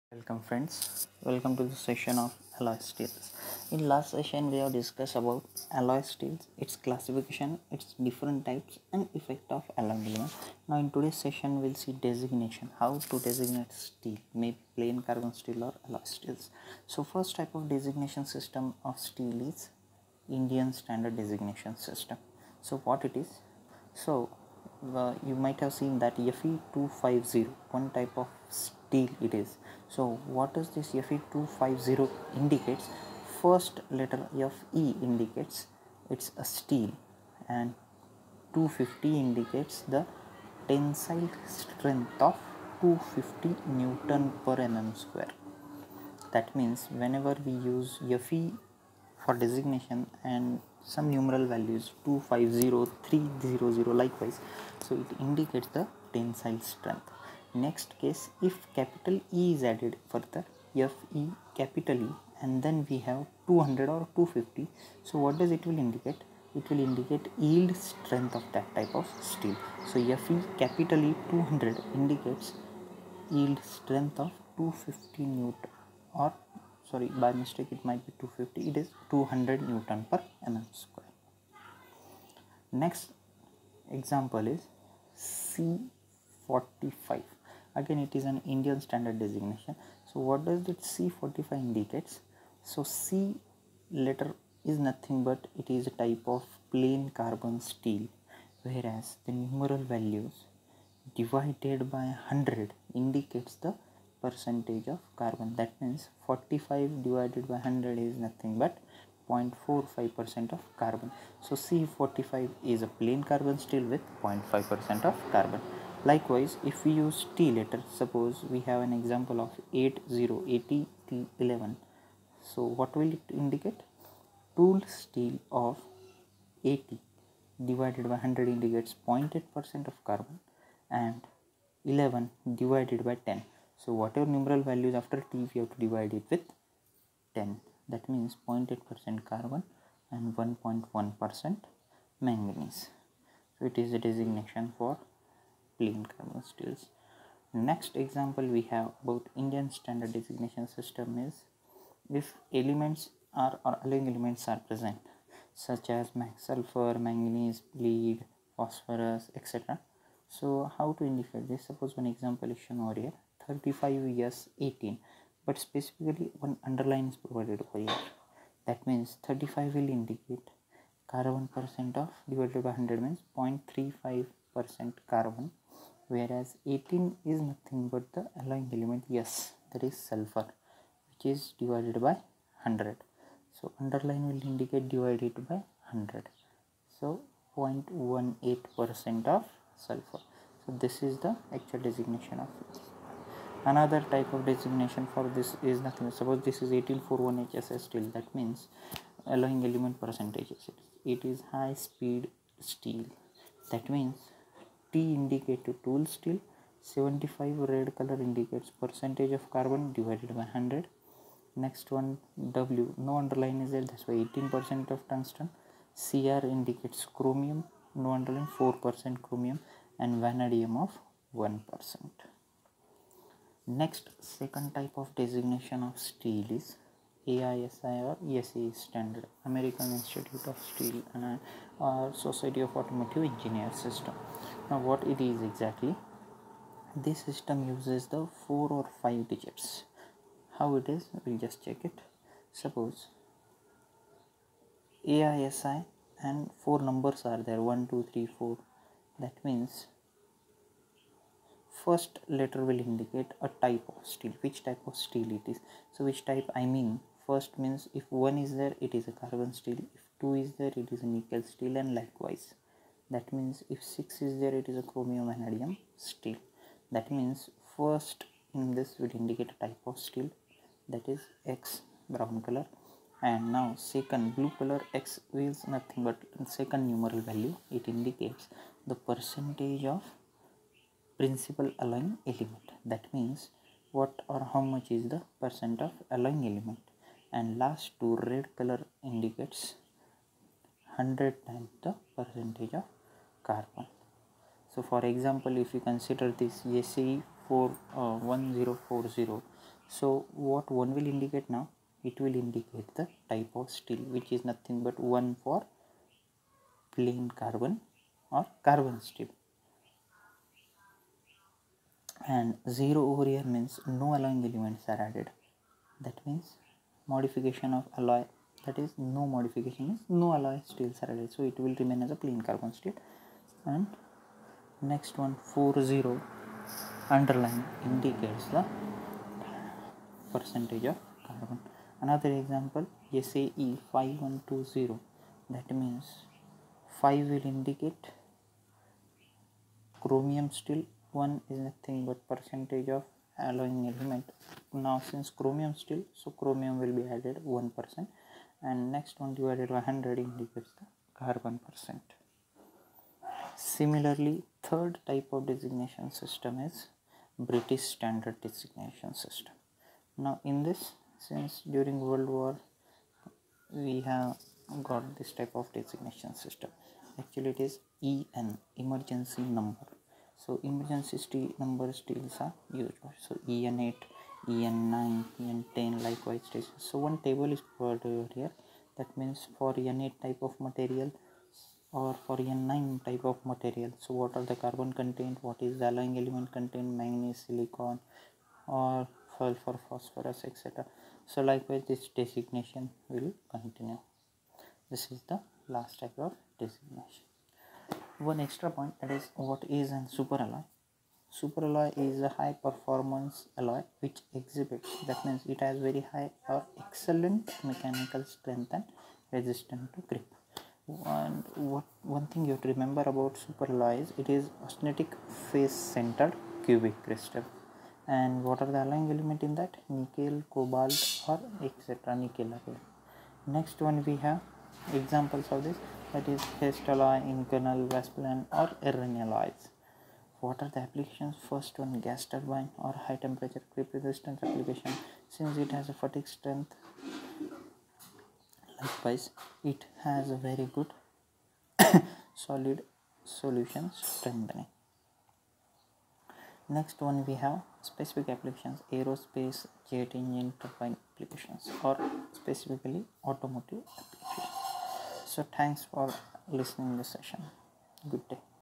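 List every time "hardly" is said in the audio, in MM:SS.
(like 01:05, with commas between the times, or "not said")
not said.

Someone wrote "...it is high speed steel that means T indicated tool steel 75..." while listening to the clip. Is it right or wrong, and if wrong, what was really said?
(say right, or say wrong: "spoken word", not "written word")
right.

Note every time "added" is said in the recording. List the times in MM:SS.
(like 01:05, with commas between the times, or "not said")
00:59, 05:15, 05:47.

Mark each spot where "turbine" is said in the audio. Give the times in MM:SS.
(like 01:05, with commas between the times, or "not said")
07:12, 07:30.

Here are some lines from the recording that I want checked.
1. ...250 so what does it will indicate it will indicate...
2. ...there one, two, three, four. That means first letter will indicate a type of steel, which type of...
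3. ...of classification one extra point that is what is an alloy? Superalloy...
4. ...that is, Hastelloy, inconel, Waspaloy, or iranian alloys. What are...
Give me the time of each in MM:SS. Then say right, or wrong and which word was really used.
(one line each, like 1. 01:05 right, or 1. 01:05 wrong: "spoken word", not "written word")
1. 01:04 right
2. 04:07 right
3. 06:36 wrong: "designation", not "classification"
4. 07:06 right.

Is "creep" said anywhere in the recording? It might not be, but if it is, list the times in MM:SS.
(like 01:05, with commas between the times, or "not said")
06:50, 07:13.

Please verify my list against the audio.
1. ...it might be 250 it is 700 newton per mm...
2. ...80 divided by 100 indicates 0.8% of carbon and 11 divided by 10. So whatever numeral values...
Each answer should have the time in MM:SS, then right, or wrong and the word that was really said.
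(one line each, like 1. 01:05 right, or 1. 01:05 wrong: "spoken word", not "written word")
1. 01:17 wrong: "200", not "700"
2. 02:06 right.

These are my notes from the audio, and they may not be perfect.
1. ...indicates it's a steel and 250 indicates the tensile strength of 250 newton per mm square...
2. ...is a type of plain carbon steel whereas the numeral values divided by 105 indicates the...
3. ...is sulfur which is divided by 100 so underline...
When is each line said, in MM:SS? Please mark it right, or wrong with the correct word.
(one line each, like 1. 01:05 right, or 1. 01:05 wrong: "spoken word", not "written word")
1. 00:35 right
2. 01:35 wrong: "100", not "105"
3. 02:59 right.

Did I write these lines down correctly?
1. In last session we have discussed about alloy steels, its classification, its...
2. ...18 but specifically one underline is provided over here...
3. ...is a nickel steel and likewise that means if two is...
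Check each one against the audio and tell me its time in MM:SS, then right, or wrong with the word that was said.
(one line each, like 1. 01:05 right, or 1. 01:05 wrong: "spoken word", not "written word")
1. 00:03 right
2. 02:44 right
3. 04:20 wrong: "six", not "two".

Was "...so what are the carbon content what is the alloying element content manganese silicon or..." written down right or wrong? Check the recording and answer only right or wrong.
right.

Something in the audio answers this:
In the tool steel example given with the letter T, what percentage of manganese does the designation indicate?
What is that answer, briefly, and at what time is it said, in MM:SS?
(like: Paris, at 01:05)
1.1%, at 02:20.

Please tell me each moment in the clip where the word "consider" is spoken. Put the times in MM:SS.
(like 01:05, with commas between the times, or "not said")
04:55.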